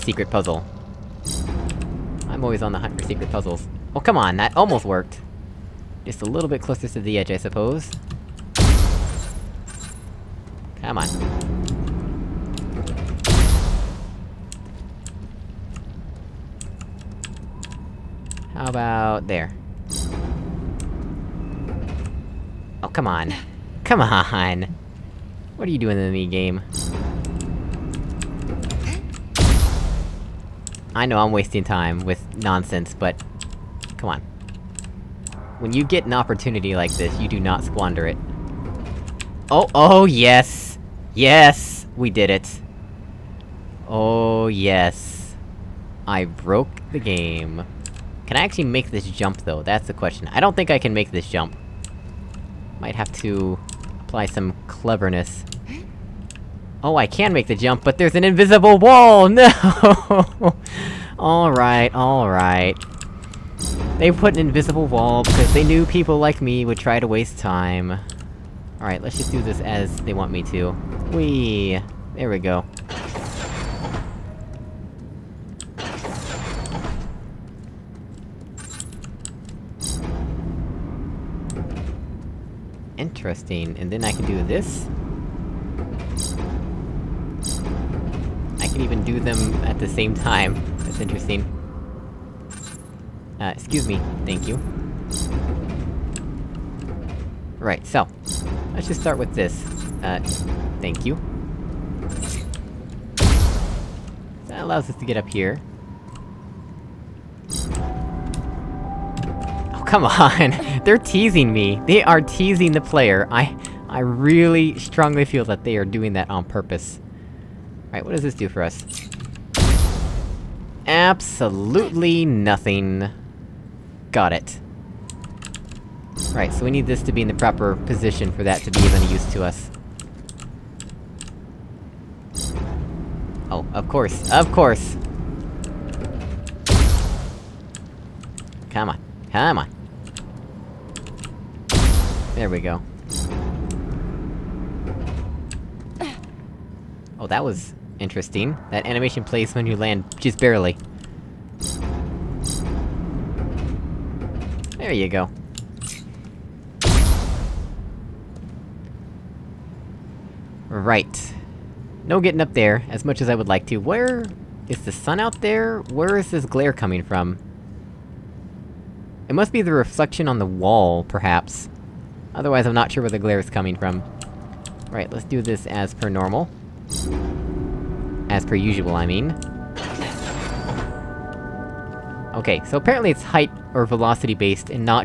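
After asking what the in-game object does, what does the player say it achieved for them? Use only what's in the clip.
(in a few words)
Absolutely nothing.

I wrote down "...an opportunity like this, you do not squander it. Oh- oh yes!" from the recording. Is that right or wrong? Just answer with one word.
right.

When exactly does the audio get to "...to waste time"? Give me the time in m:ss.
1:07.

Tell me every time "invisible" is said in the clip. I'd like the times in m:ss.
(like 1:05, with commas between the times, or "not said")
0:58, 1:04.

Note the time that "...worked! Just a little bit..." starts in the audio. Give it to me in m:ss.
0:04.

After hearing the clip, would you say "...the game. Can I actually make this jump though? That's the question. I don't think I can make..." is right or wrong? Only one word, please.
right.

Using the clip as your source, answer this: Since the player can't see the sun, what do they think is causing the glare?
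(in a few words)
reflection on the wall.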